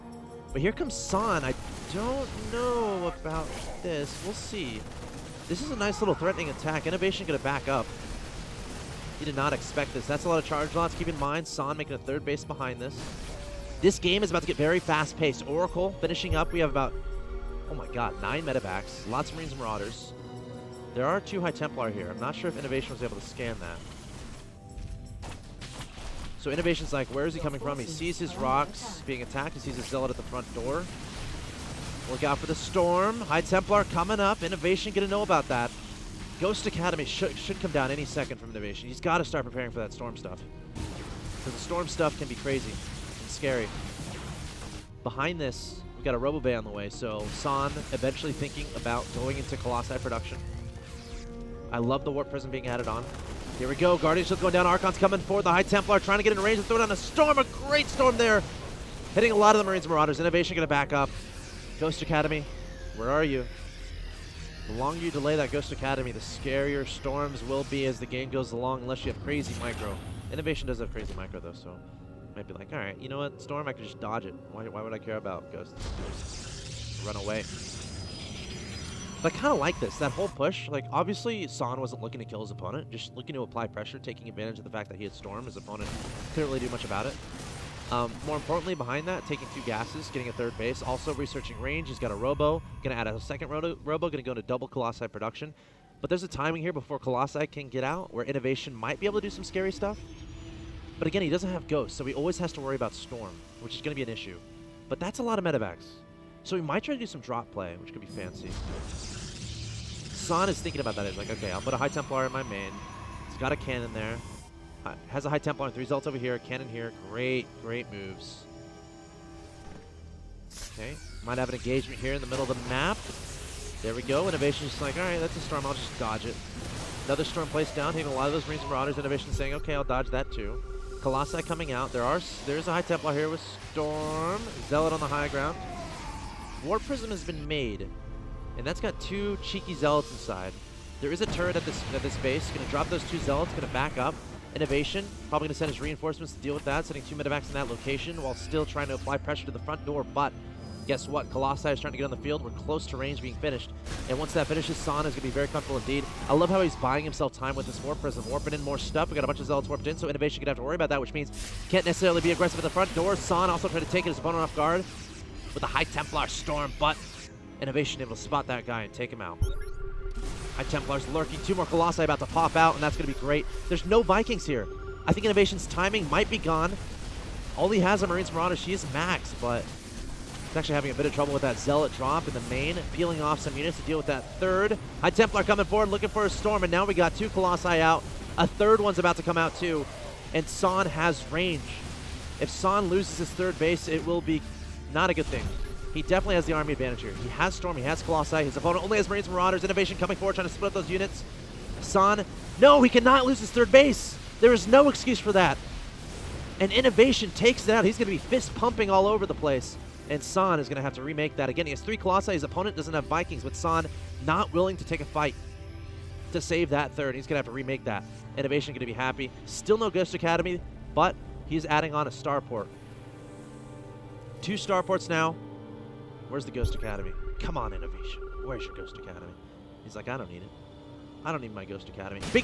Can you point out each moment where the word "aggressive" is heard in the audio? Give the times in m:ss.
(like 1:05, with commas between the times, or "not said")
2:42.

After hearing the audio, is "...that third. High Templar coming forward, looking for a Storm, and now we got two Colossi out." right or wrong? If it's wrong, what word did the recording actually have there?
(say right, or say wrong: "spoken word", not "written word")
right.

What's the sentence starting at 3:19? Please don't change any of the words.
Innovation coming forward, trying to split up those units.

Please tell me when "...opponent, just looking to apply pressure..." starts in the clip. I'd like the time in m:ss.
1:22.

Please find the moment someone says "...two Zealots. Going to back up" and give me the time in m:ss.
2:23.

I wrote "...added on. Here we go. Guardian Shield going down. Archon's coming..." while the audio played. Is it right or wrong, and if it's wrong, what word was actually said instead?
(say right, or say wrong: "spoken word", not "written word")
right.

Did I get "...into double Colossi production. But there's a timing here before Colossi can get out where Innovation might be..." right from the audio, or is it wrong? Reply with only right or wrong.
right.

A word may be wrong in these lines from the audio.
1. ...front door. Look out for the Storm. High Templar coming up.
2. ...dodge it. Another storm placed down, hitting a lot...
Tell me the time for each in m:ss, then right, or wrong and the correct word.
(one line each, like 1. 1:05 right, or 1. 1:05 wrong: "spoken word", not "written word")
1. 0:30 right
2. 2:05 right.